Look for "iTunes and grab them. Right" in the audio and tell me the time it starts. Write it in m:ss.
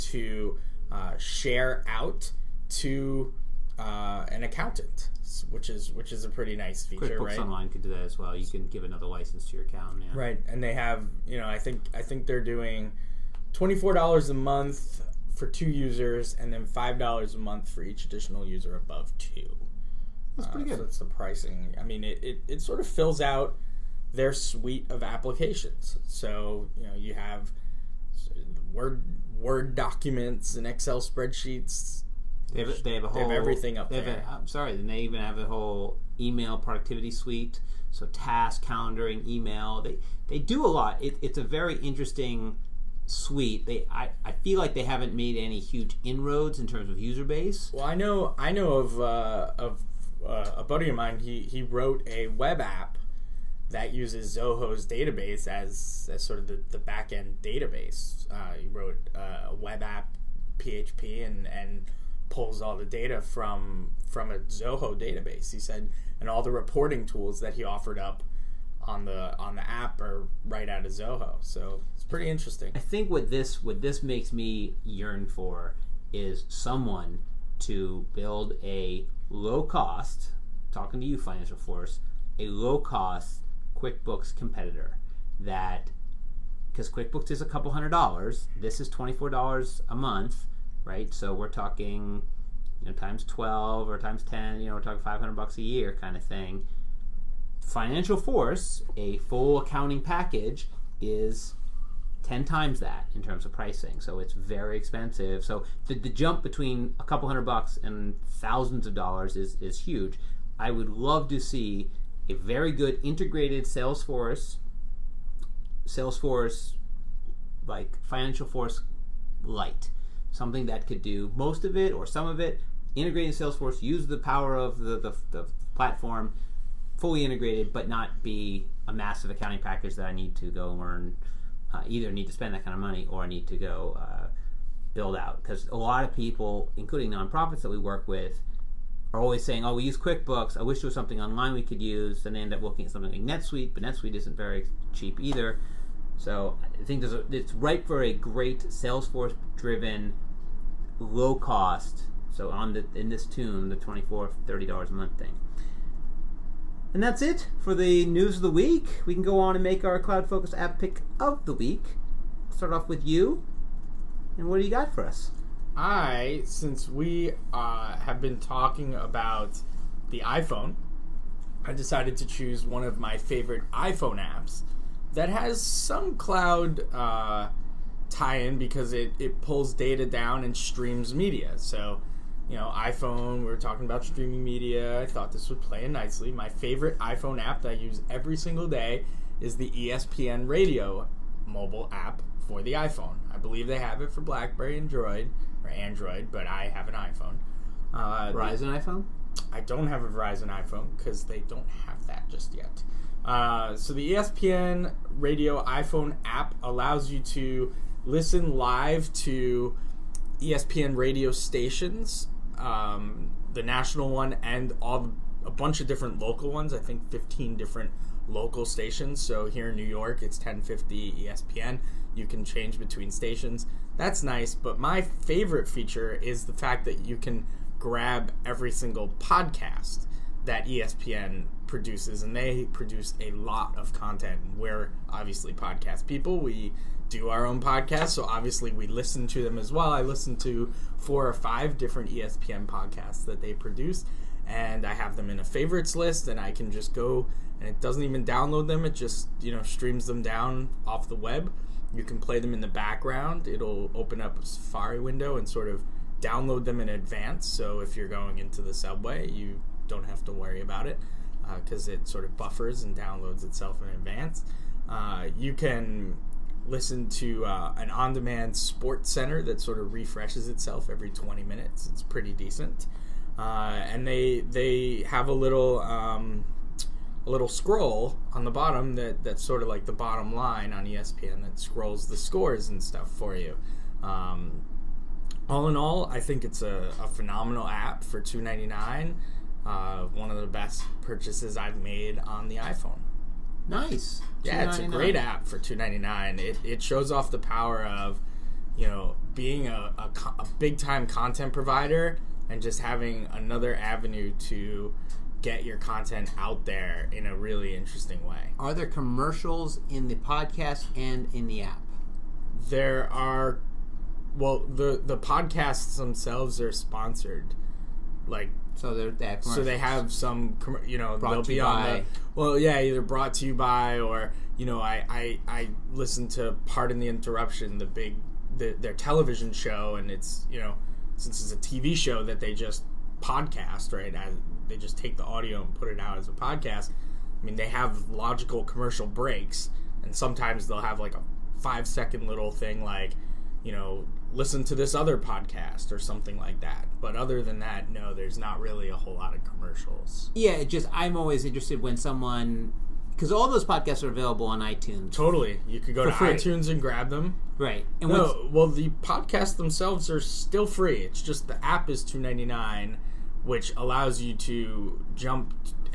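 5:56.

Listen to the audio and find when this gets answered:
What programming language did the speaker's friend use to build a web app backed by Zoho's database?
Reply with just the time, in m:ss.
1:00.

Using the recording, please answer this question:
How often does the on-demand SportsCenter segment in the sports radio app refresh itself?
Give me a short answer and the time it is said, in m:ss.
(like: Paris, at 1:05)
every 20 minutes, at 4:30.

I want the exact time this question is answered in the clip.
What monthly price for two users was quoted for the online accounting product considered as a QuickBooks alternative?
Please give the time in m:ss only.
0:13.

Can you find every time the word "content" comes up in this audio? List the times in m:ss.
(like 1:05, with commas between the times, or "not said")
3:53, 5:01, 5:05.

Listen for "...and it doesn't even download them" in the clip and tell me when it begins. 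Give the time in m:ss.
4:07.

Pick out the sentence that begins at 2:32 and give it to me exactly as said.
So on the in this tune, the 24 30 dollars a month thing.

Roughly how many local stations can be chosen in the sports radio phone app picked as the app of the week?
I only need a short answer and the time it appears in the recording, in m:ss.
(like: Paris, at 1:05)
15, at 3:37.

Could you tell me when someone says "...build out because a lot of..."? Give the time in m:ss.
2:14.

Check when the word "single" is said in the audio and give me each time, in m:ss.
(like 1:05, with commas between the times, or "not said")
3:08, 3:48.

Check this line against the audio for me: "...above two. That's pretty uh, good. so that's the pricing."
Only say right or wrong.
right.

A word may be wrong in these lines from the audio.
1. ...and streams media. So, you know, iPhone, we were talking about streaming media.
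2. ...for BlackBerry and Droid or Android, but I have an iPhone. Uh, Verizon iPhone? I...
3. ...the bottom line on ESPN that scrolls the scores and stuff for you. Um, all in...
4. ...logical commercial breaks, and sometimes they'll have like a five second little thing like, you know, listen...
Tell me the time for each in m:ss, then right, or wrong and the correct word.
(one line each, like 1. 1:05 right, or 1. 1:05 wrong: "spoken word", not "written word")
1. 3:00 right
2. 3:14 right
3. 4:39 right
4. 5:38 right.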